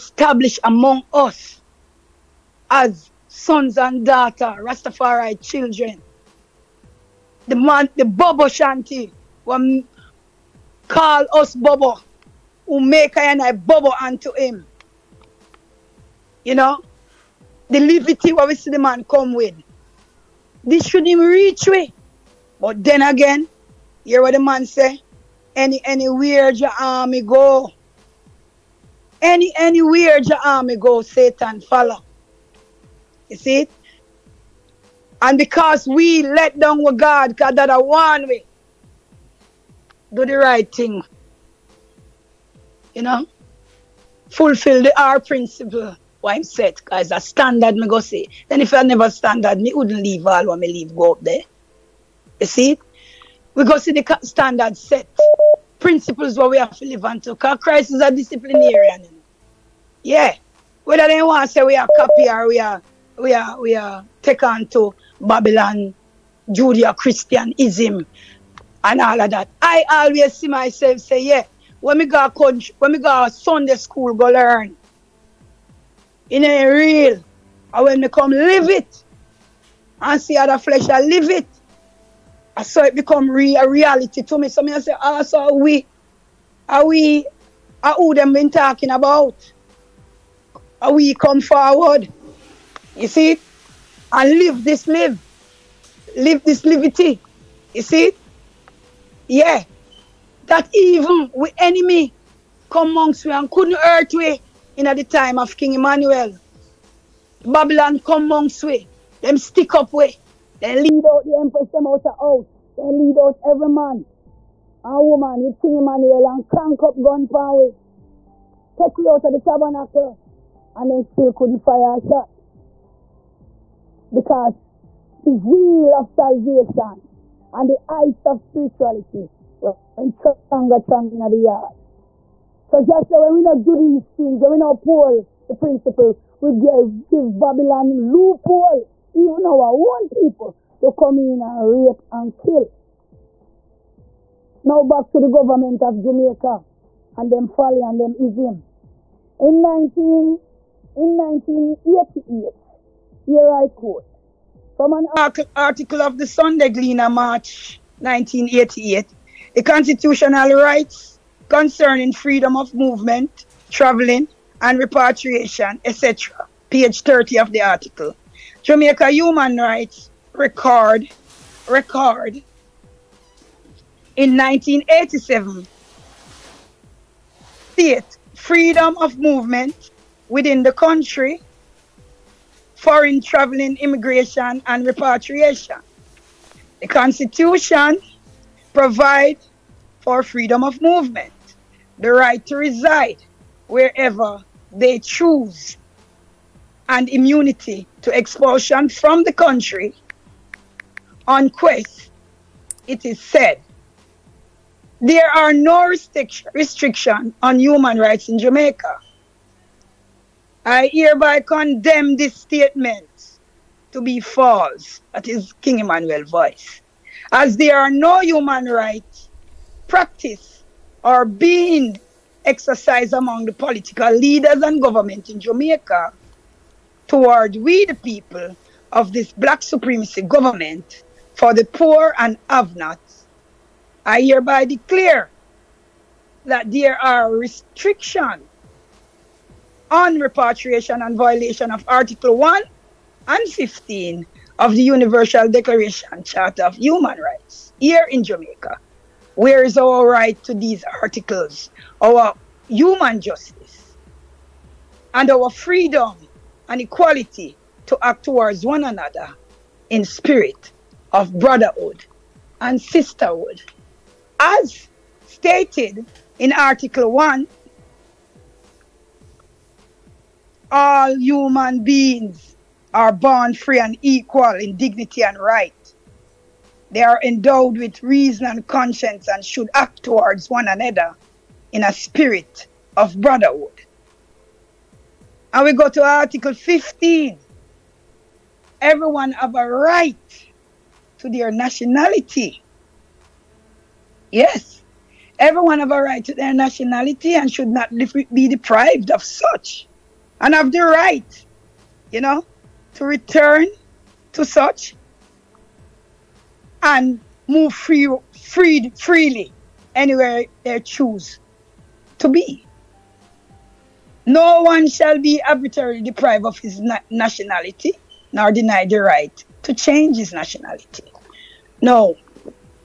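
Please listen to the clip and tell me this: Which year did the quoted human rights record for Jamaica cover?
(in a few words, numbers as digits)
1987.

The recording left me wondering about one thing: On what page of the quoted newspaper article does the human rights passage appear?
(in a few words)
30.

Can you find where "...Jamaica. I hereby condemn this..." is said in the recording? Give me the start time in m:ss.
3:28.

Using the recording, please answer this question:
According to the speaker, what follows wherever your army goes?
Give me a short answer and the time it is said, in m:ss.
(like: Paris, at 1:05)
Satan, at 0:31.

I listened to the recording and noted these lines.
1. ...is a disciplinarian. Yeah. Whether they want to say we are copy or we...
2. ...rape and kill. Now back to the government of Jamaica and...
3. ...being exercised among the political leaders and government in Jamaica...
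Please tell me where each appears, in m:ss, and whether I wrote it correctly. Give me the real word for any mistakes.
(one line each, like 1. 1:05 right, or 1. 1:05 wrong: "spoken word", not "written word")
1. 0:57 right
2. 2:21 right
3. 3:41 right.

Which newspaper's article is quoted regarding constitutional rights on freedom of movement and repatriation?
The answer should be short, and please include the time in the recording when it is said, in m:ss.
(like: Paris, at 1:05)
Sunday Gleaner, at 2:36.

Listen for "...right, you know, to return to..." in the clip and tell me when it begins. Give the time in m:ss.
5:00.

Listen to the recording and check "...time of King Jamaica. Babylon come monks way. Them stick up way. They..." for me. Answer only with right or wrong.
wrong.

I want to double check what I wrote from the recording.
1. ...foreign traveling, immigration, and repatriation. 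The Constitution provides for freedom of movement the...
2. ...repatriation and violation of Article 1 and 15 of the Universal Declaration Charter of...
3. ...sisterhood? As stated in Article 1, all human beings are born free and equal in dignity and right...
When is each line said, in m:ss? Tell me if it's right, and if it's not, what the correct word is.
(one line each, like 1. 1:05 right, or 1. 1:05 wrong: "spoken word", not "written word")
1. 3:02 right
2. 4:00 right
3. 4:22 right.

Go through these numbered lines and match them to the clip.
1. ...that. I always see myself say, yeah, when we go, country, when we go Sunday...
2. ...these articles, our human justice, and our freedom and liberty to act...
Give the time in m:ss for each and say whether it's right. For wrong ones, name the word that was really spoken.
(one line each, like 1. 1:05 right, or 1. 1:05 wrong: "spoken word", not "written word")
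1. 1:09 right
2. 4:10 wrong: "equality", not "liberty".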